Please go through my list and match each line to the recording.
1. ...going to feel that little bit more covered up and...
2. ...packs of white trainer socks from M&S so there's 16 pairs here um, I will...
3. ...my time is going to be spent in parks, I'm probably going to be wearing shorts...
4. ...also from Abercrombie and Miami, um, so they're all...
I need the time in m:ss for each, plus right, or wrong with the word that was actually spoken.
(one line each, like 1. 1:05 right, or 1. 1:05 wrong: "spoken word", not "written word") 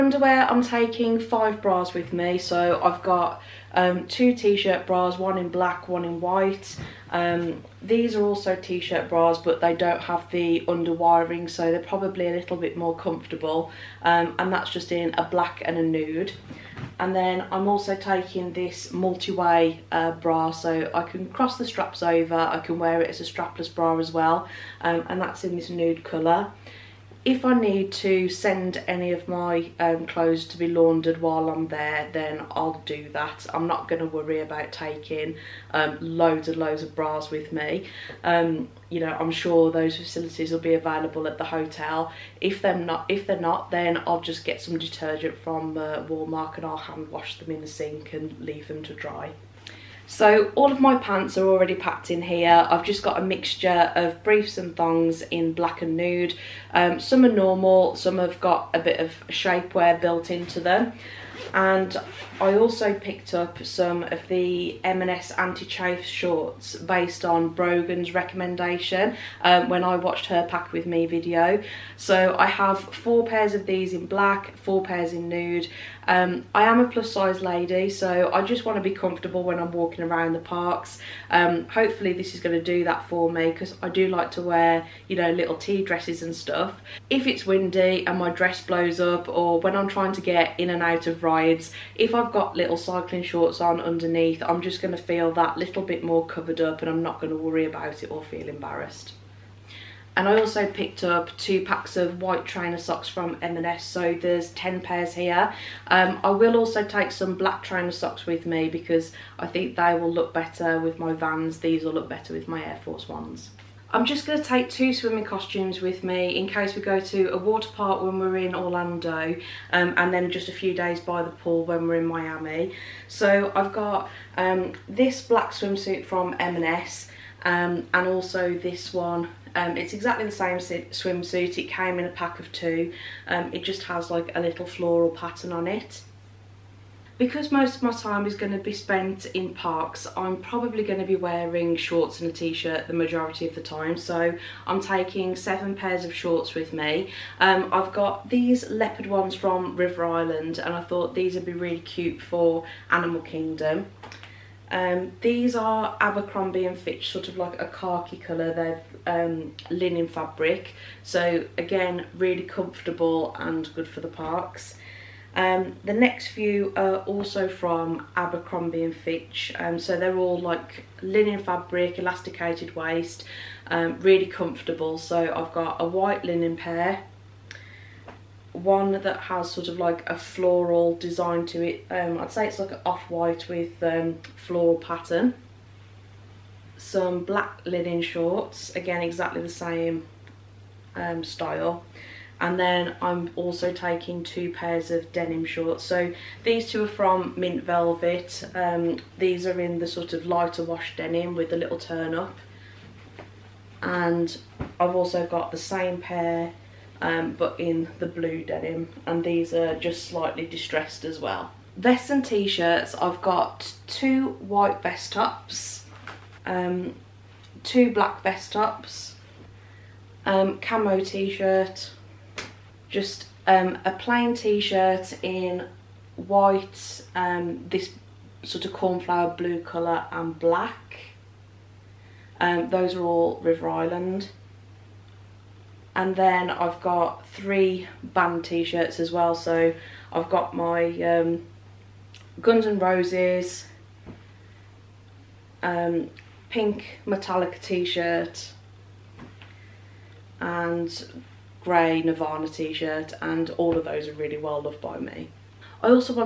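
1. 1:34 right
2. 1:41 wrong: "10", not "16"
3. 2:17 right
4. 2:46 wrong: "Fitch", not "Miami".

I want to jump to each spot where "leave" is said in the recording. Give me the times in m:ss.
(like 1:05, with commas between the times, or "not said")
0:48.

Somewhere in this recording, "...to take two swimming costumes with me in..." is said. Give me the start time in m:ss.
1:54.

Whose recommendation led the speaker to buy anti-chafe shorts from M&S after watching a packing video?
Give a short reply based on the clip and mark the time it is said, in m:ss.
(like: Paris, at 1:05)
Brogan, at 1:07.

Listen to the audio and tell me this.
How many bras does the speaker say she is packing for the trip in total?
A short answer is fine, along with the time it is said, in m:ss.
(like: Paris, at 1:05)
5, at 0:01.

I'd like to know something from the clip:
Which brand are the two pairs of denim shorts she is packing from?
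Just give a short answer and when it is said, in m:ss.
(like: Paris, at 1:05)
Mint Velvet, at 3:17.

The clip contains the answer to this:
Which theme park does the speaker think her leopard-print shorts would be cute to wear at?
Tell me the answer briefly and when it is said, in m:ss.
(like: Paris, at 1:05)
Animal Kingdom, at 2:32.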